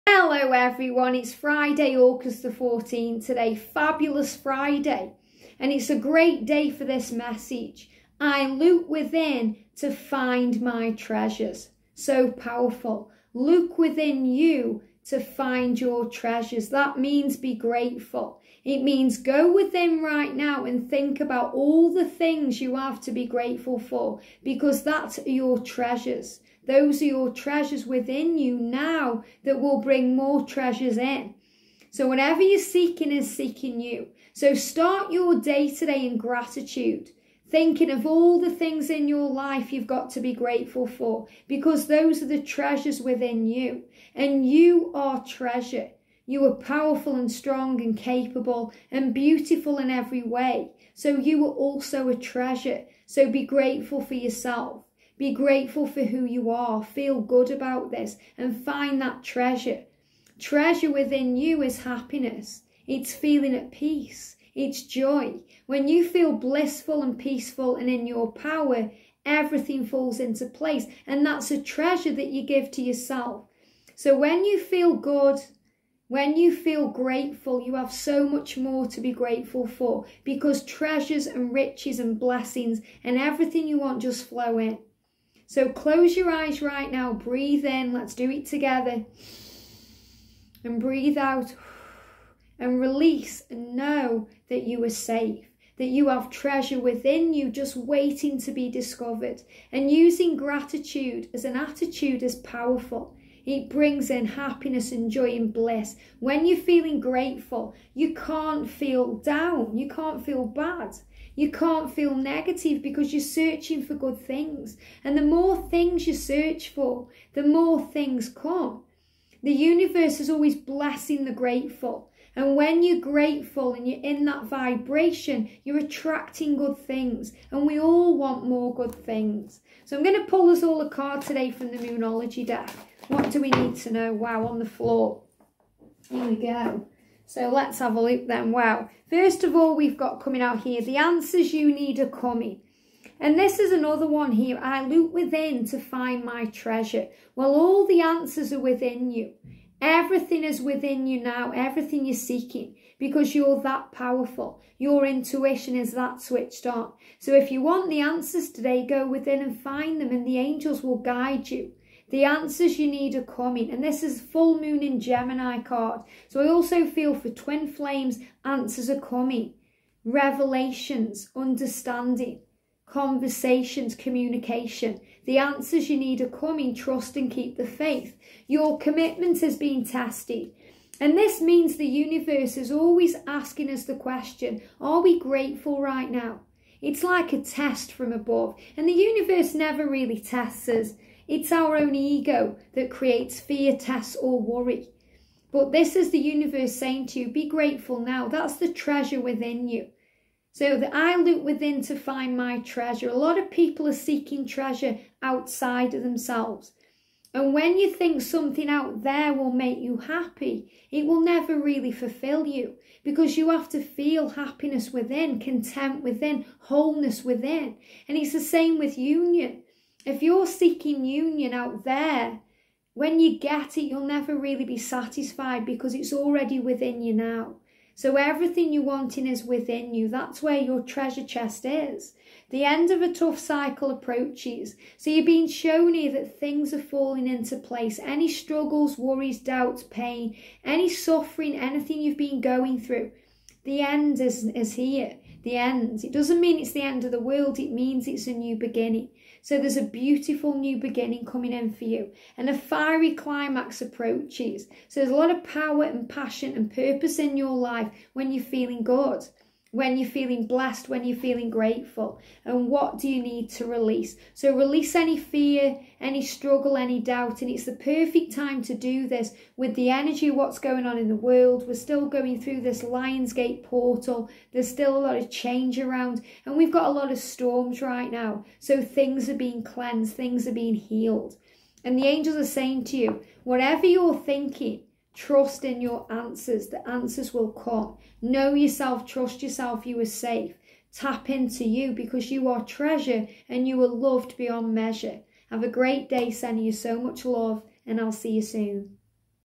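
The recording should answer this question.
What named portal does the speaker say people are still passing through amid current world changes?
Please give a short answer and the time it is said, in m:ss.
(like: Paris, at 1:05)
Lionsgate portal, at 4:32.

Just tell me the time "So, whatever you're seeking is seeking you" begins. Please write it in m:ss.
0:31.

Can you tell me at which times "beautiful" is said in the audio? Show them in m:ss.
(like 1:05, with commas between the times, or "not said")
0:49, 4:09.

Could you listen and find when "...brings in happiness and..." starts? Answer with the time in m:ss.
1:43.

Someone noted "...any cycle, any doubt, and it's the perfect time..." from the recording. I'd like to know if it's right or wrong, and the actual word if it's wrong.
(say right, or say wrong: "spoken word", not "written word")
wrong: "struggle", not "cycle".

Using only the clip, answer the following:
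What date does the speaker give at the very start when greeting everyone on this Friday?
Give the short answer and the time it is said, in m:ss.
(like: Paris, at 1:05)
August 14th, at 0:01.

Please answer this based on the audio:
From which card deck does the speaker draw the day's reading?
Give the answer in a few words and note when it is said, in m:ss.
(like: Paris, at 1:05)
Moonology, at 2:11.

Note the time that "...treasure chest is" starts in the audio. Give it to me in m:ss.
3:50.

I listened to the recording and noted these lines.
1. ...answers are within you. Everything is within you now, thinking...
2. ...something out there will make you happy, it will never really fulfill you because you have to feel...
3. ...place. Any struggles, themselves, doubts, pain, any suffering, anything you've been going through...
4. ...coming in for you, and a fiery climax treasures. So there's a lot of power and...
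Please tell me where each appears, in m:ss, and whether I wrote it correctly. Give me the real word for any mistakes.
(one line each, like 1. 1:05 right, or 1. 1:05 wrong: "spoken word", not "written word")
1. 2:28 wrong: "everything", not "thinking"
2. 3:28 right
3. 3:57 wrong: "worries", not "themselves"
4. 4:11 wrong: "approaches", not "treasures".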